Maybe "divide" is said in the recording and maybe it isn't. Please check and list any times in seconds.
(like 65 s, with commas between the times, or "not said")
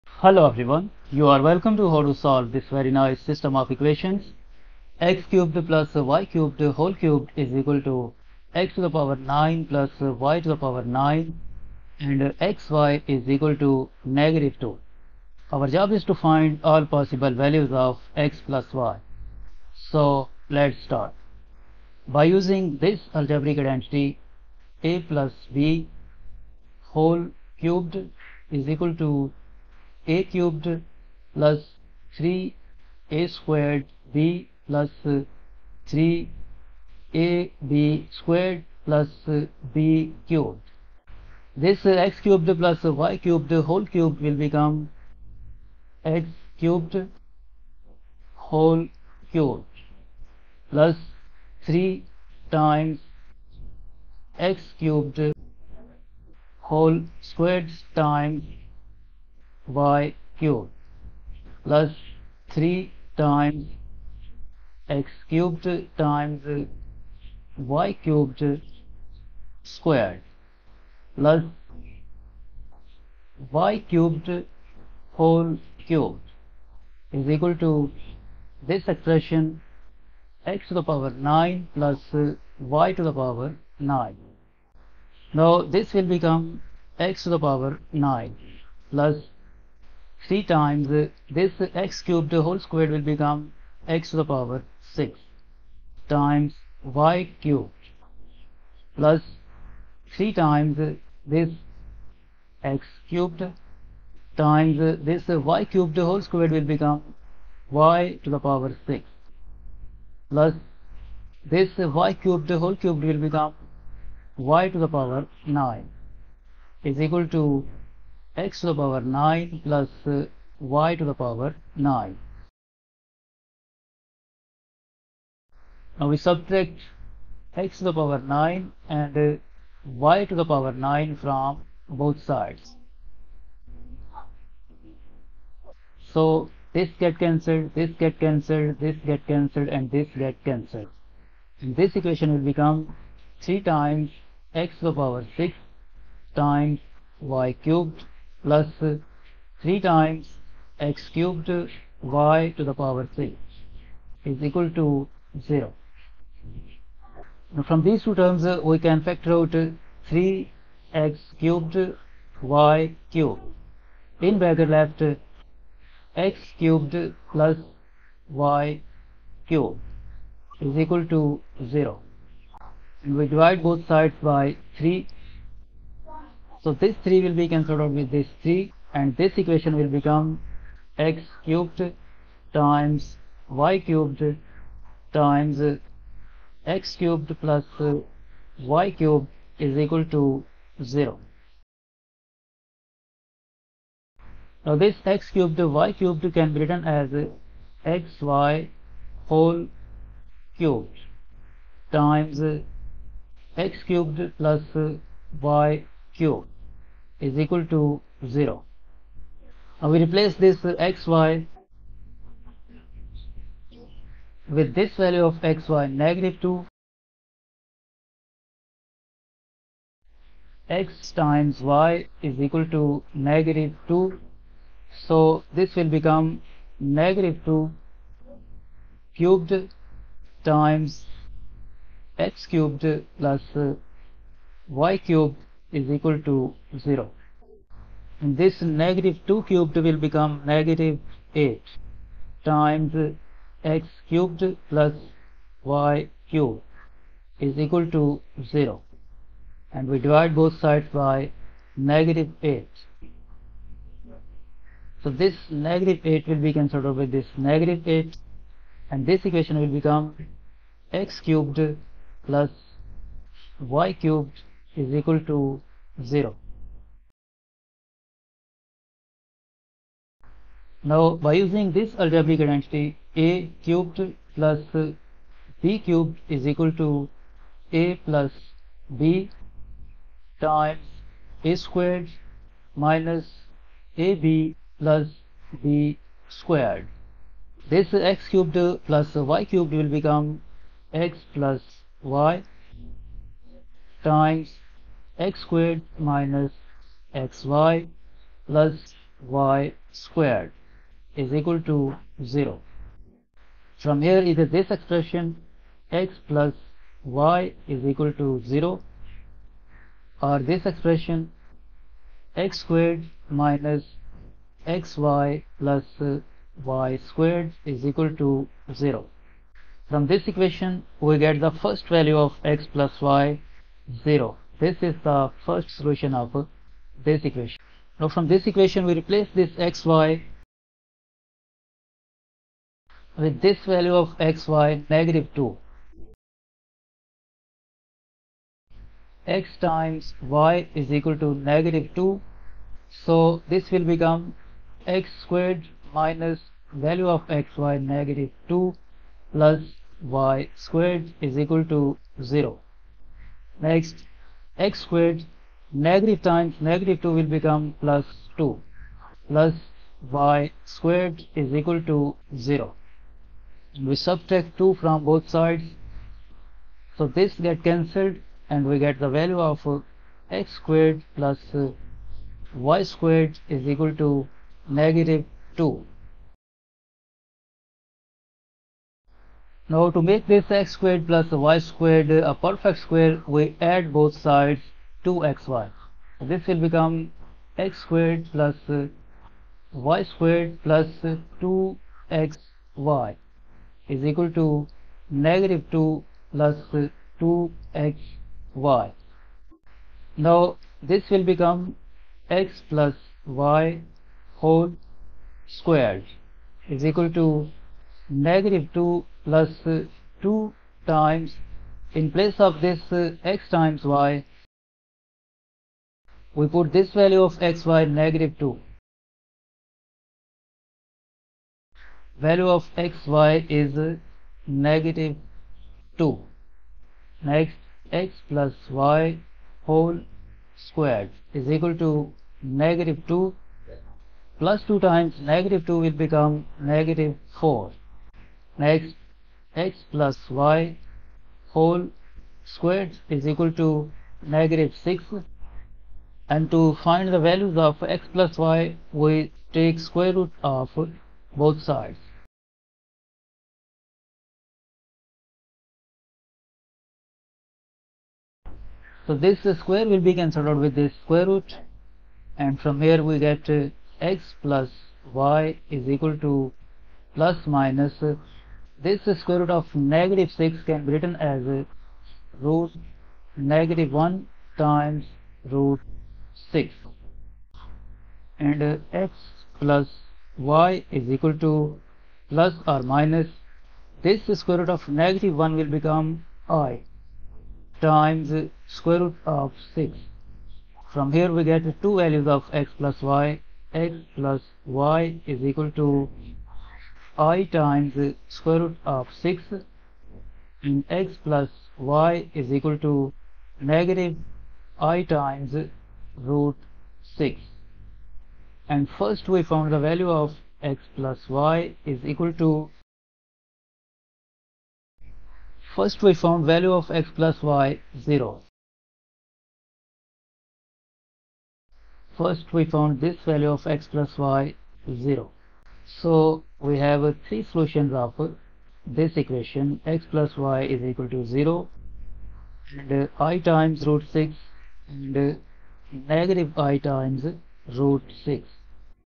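173 s, 249 s.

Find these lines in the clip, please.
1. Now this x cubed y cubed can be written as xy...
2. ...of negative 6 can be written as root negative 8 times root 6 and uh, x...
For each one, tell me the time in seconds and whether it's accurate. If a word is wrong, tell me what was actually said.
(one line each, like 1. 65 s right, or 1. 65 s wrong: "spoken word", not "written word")
1. 194 s right
2. 469 s wrong: "1", not "8".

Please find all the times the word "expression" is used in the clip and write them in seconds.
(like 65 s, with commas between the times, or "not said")
78 s, 304 s, 310 s.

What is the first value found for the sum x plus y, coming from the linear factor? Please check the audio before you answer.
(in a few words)
0.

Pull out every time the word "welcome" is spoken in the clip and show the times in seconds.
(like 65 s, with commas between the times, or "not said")
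1 s.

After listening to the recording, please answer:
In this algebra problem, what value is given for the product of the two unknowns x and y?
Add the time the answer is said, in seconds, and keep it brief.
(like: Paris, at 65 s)
-2, at 12 s.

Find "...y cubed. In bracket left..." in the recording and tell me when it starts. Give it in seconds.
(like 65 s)
162 s.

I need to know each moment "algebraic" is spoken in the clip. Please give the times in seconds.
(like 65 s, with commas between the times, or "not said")
23 s, 271 s.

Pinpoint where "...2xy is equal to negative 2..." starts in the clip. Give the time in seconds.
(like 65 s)
391 s.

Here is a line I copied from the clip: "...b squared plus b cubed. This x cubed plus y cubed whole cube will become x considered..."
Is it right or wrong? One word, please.
wrong.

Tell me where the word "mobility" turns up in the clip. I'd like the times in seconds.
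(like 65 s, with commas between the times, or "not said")
not said.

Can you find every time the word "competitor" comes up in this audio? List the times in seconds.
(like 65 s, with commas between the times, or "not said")
not said.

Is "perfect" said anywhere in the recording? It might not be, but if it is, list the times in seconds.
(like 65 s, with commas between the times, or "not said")
382 s.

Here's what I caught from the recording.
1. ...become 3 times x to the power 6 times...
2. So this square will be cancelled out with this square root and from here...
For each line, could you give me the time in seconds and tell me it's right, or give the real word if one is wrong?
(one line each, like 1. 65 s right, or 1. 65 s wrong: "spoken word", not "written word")
1. 142 s right
2. 459 s right.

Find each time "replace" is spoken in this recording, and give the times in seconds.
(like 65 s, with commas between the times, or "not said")
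210 s, 328 s.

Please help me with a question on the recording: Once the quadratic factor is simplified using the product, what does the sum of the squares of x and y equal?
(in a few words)
-2.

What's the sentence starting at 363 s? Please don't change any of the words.
We subtract 2 from both sides.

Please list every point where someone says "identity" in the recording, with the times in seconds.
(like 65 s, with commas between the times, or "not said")
23 s, 272 s.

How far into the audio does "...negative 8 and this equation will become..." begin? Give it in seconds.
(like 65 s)
257 s.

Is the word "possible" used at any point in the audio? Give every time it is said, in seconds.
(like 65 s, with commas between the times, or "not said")
16 s.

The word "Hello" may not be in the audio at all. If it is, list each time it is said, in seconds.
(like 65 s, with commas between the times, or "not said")
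0 s.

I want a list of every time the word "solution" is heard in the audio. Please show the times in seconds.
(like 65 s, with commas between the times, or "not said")
325 s, 527 s.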